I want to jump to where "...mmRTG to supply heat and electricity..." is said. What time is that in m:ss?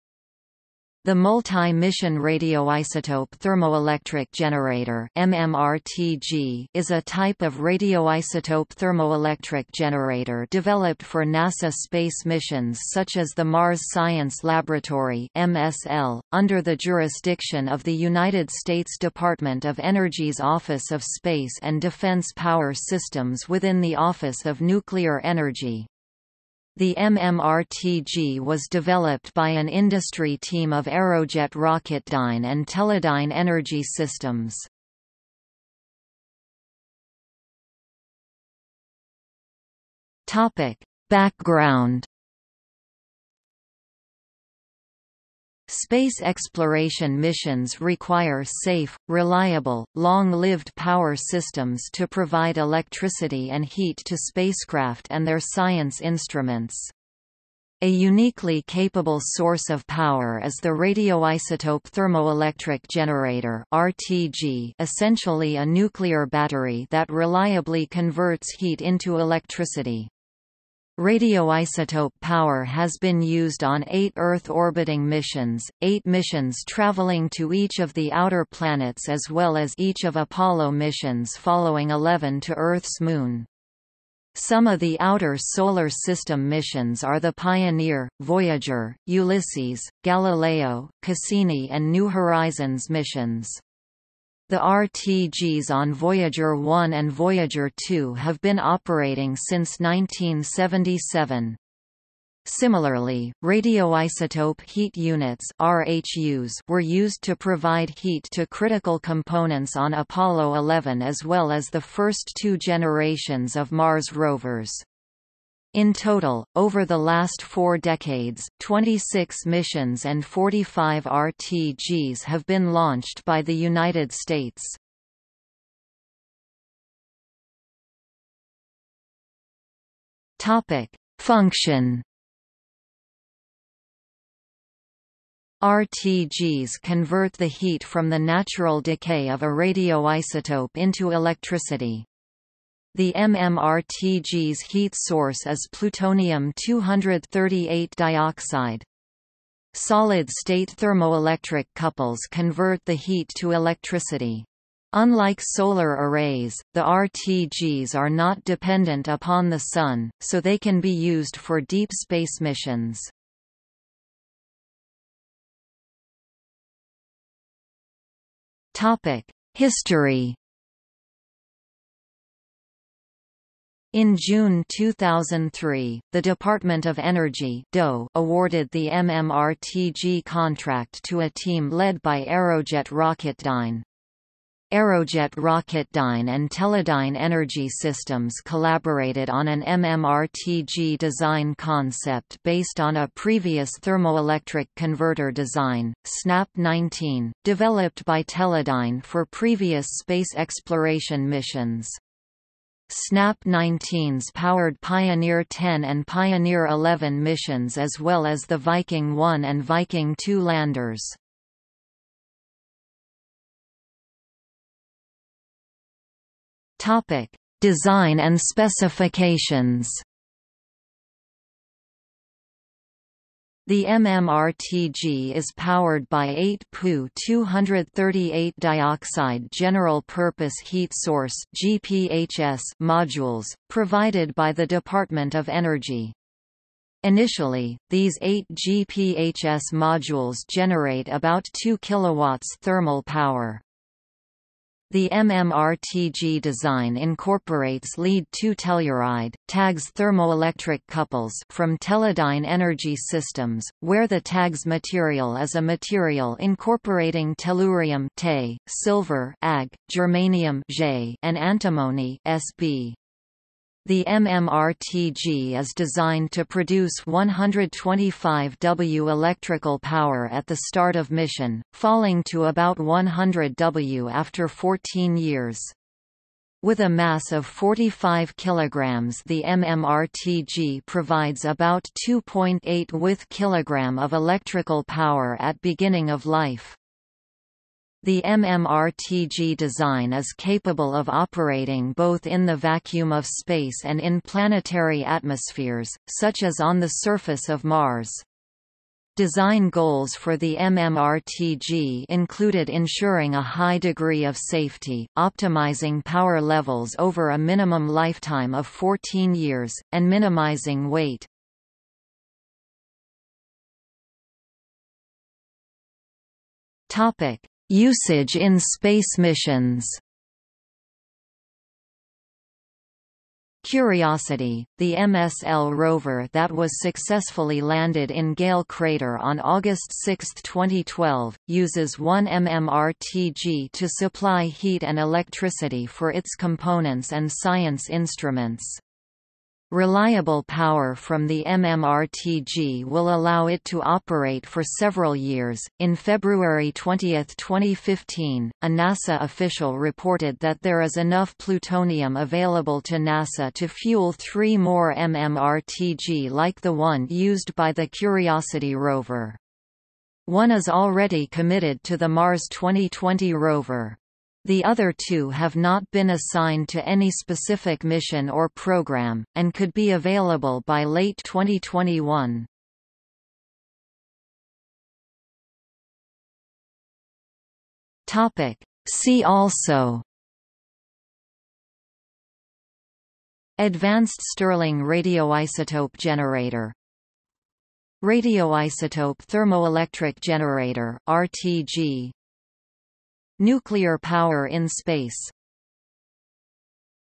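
5:32.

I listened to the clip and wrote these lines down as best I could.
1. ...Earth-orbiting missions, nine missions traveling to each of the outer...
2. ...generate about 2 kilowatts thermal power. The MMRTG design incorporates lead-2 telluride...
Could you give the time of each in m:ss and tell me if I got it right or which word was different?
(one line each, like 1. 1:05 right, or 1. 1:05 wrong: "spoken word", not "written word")
1. 1:14 wrong: "eight", not "nine"
2. 4:00 right.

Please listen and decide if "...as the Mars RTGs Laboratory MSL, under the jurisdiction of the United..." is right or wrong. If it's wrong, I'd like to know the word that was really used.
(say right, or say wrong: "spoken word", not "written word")
wrong: "Science", not "RTGs".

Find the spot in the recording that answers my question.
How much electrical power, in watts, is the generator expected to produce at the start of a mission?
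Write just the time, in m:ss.
4:27.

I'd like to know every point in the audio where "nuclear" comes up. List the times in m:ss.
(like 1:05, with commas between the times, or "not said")
0:24, 1:05, 6:33.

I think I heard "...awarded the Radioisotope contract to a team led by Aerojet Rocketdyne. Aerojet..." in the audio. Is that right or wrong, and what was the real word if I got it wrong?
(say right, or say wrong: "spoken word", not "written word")
wrong: "MMRTG", not "Radioisotope".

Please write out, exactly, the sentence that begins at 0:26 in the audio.
The MMRTG was developed by an industry team of Aerojet Rocketdyne and Teledyne Energy Systems.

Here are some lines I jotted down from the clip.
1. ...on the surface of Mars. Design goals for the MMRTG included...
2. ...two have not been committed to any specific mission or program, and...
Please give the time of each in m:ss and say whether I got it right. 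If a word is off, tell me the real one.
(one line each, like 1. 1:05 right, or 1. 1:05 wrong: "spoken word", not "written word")
1. 4:56 right
2. 6:04 wrong: "assigned", not "committed".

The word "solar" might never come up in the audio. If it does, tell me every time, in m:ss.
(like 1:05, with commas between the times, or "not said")
1:25, 2:35.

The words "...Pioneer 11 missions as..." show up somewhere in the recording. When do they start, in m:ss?
3:26.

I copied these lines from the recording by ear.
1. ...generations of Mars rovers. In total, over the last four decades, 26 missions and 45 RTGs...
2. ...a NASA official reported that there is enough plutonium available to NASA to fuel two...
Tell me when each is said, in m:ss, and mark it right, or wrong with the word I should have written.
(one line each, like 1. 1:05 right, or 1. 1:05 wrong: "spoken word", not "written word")
1. 1:52 right
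2. 5:48 wrong: "three", not "two".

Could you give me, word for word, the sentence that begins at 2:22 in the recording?
The MMRTG's heat source is plutonium-238 dioxide.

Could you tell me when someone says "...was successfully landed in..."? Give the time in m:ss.
5:26.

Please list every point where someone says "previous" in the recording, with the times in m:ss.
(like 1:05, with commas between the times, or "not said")
3:13, 3:19.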